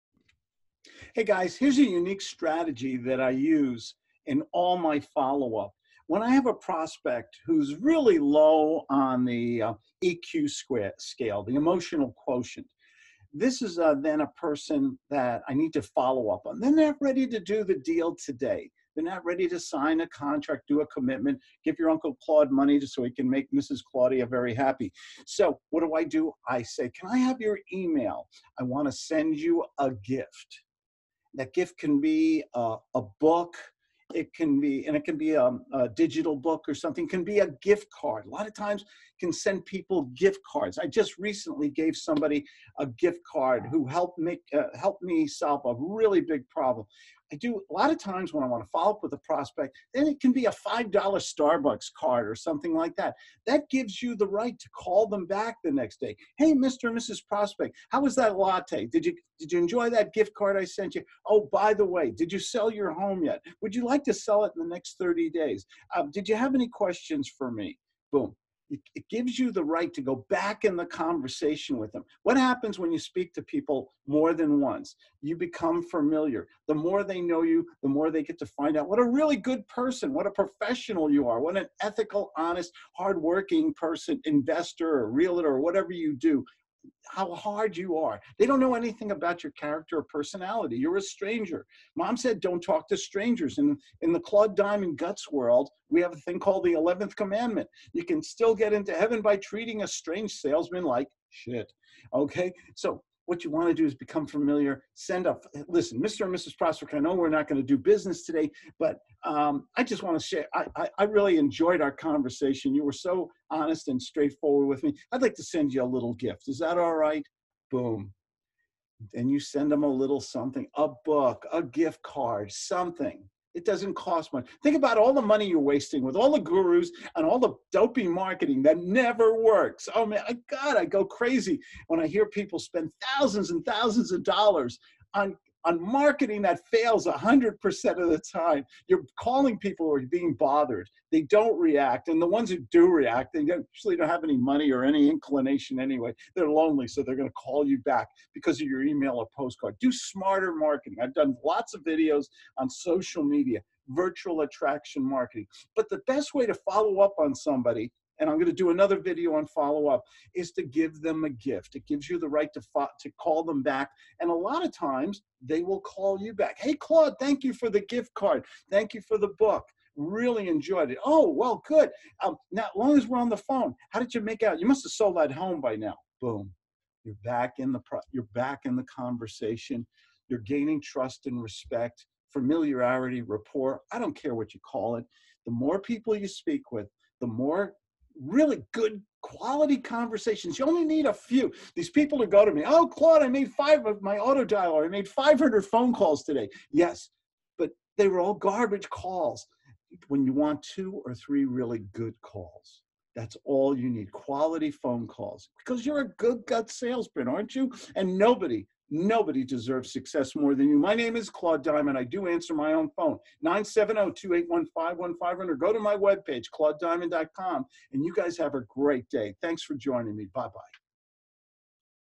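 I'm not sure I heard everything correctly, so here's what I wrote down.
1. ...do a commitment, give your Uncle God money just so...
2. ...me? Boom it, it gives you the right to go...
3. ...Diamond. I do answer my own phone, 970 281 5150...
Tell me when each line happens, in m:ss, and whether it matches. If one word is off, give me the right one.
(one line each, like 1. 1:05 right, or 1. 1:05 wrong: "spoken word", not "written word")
1. 0:20 wrong: "Claude", not "God"
2. 1:07 right
3. 3:31 right.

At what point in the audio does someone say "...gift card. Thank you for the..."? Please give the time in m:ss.
2:47.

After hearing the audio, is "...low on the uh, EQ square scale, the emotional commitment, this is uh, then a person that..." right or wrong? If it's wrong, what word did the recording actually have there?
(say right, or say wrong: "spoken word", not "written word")
wrong: "quotient", not "commitment".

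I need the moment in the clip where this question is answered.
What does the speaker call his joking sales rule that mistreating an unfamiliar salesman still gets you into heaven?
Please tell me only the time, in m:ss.
1:36.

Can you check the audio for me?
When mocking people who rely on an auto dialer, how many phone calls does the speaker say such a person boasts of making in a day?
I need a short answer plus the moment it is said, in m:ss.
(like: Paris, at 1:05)
500, at 3:15.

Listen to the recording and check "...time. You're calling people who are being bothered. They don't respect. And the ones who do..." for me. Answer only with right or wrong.
wrong.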